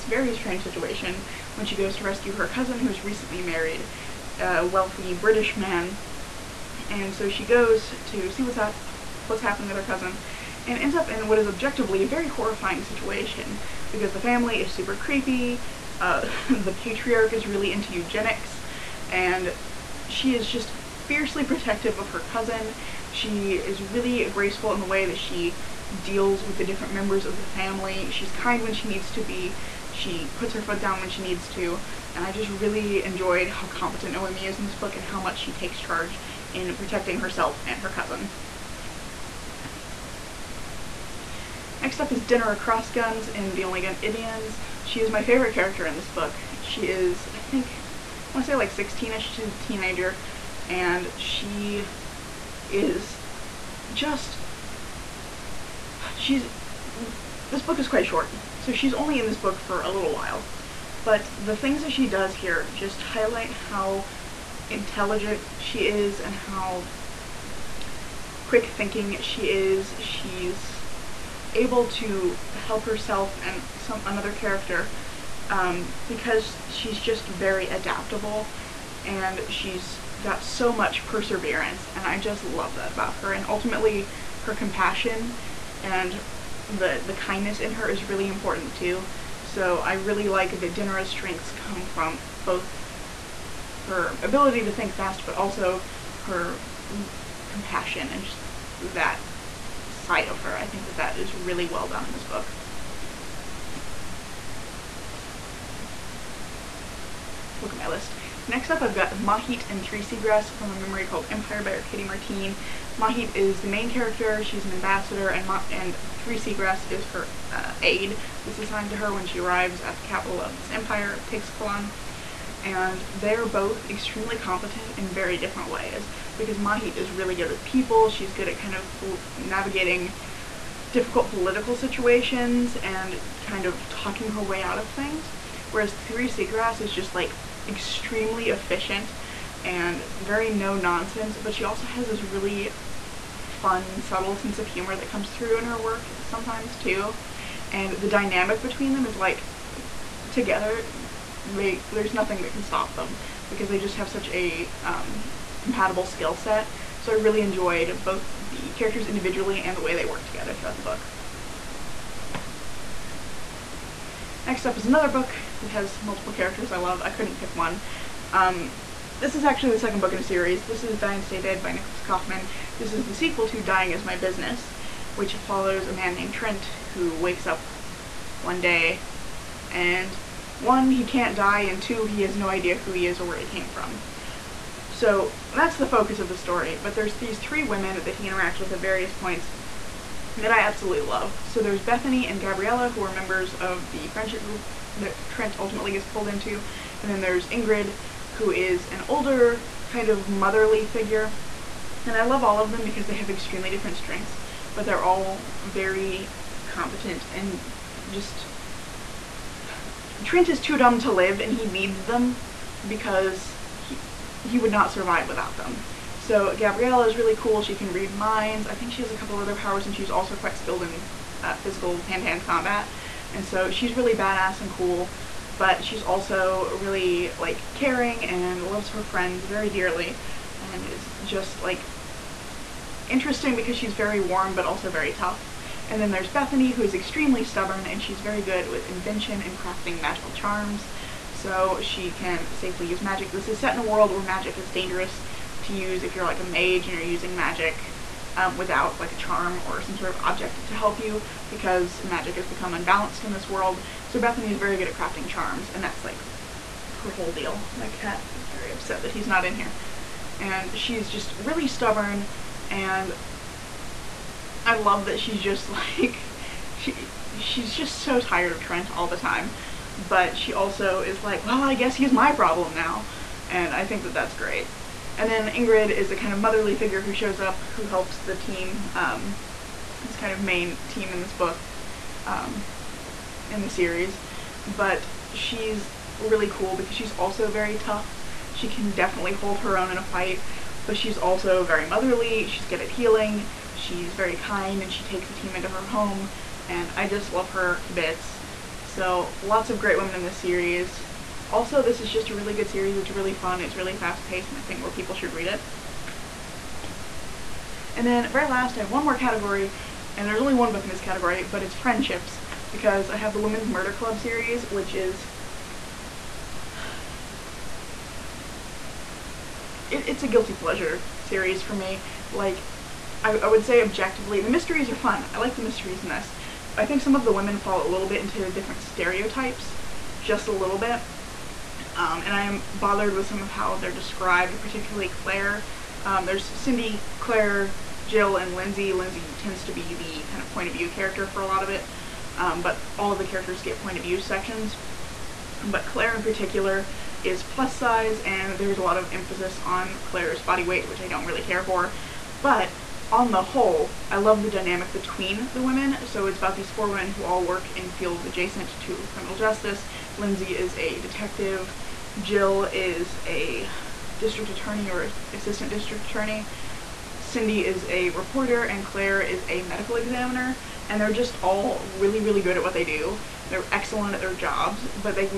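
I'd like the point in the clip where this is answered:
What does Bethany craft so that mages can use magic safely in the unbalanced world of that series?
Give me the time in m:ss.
3:59.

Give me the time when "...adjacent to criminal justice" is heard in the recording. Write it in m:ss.
5:58.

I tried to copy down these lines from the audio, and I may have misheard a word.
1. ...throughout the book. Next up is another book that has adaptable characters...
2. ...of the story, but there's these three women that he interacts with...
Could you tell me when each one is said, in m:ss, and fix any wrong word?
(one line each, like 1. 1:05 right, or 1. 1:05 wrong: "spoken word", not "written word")
1. 2:40 wrong: "multiple", not "adaptable"
2. 3:06 right.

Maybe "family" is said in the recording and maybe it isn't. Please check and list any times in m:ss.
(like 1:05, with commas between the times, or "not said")
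0:14, 0:27.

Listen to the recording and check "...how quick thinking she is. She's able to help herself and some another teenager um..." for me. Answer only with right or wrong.
wrong.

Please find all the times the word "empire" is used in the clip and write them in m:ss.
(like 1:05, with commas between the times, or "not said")
1:51, 2:00.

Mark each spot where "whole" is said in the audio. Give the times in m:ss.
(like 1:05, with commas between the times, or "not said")
4:17, 5:53.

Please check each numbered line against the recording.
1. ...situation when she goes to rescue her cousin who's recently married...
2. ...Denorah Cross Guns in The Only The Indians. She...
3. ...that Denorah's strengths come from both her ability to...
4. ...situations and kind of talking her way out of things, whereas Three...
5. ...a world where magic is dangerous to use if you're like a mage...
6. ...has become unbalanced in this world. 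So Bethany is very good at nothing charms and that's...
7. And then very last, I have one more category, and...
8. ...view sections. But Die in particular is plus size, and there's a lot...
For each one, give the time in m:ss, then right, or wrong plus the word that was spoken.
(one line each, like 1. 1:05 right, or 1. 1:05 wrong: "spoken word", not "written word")
1. 0:00 right
2. 0:42 wrong: "Good", not "The"
3. 1:30 right
4. 2:11 right
5. 4:03 right
6. 4:12 wrong: "crafting", not "nothing"
7. 5:07 right
8. 5:44 wrong: "Claire", not "Die".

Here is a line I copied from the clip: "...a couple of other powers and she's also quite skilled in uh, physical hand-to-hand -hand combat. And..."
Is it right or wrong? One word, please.
right.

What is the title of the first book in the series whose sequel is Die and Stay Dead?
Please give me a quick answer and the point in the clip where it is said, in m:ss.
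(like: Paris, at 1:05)
Dying Is My Business, at 2:53.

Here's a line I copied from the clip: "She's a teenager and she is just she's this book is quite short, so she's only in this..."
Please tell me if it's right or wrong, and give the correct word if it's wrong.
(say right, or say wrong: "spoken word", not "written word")
right.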